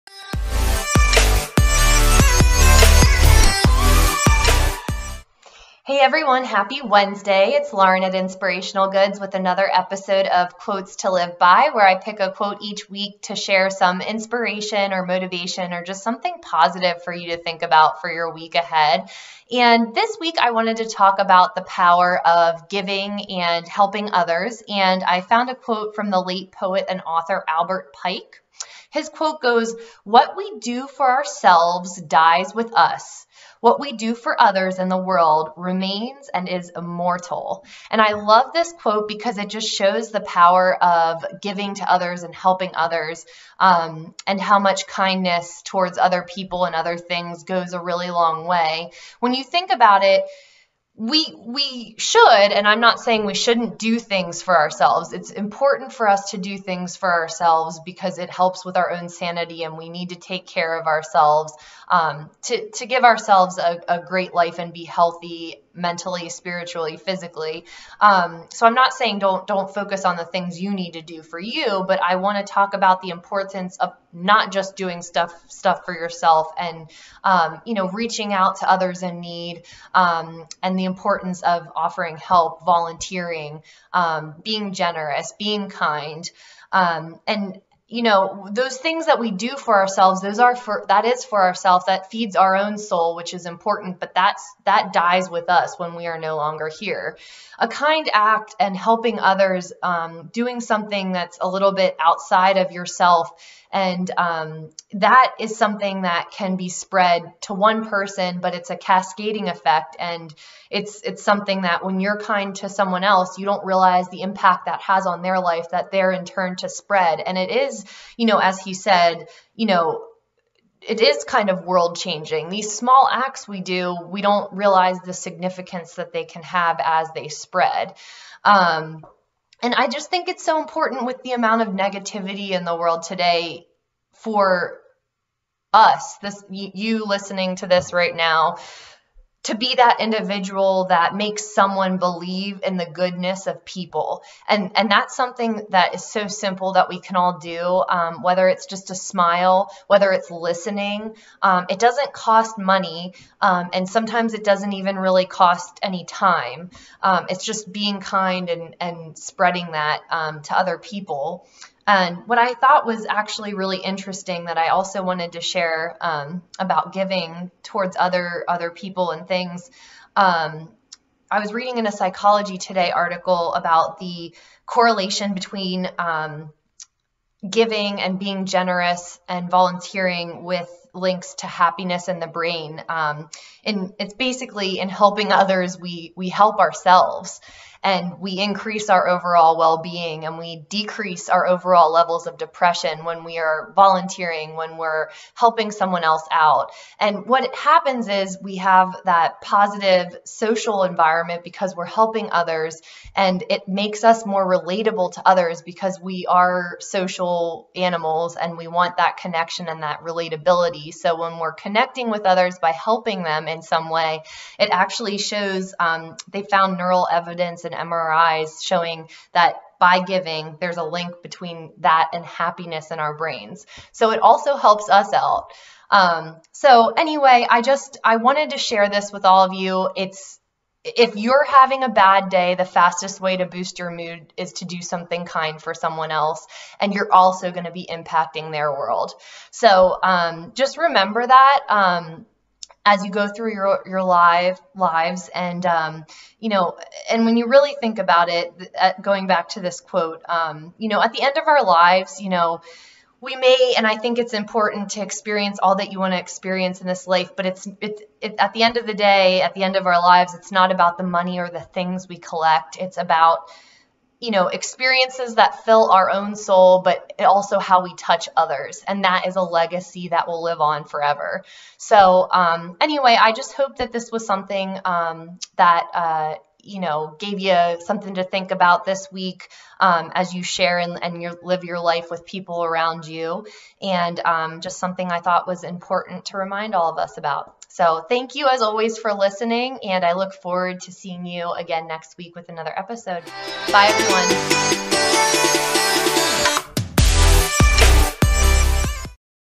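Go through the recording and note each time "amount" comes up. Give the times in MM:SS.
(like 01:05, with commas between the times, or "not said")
02:11.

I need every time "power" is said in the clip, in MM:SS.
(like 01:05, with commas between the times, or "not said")
00:21, 00:40.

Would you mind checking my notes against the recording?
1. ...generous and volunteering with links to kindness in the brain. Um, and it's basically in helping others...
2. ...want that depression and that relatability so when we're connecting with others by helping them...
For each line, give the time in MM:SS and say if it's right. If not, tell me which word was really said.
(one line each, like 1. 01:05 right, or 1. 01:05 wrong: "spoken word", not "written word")
1. 02:58 wrong: "happiness", not "kindness"
2. 03:28 wrong: "connection", not "depression".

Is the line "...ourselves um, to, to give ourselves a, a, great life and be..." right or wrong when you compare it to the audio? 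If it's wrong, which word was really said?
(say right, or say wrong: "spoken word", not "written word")
right.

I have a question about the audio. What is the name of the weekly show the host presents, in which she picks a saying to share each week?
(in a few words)
Quotes to Live By.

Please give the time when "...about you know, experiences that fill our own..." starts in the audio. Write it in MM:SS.
04:22.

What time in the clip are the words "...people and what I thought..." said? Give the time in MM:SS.
02:40.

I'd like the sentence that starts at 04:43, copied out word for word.
And um, just something I thought was important to remind all of us about.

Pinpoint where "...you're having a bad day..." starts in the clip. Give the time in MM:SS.
03:51.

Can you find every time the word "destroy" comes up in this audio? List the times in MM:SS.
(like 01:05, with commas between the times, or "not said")
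not said.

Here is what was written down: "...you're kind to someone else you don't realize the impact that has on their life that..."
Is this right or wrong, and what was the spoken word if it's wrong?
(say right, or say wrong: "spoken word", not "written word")
right.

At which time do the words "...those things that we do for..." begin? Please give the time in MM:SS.
01:28.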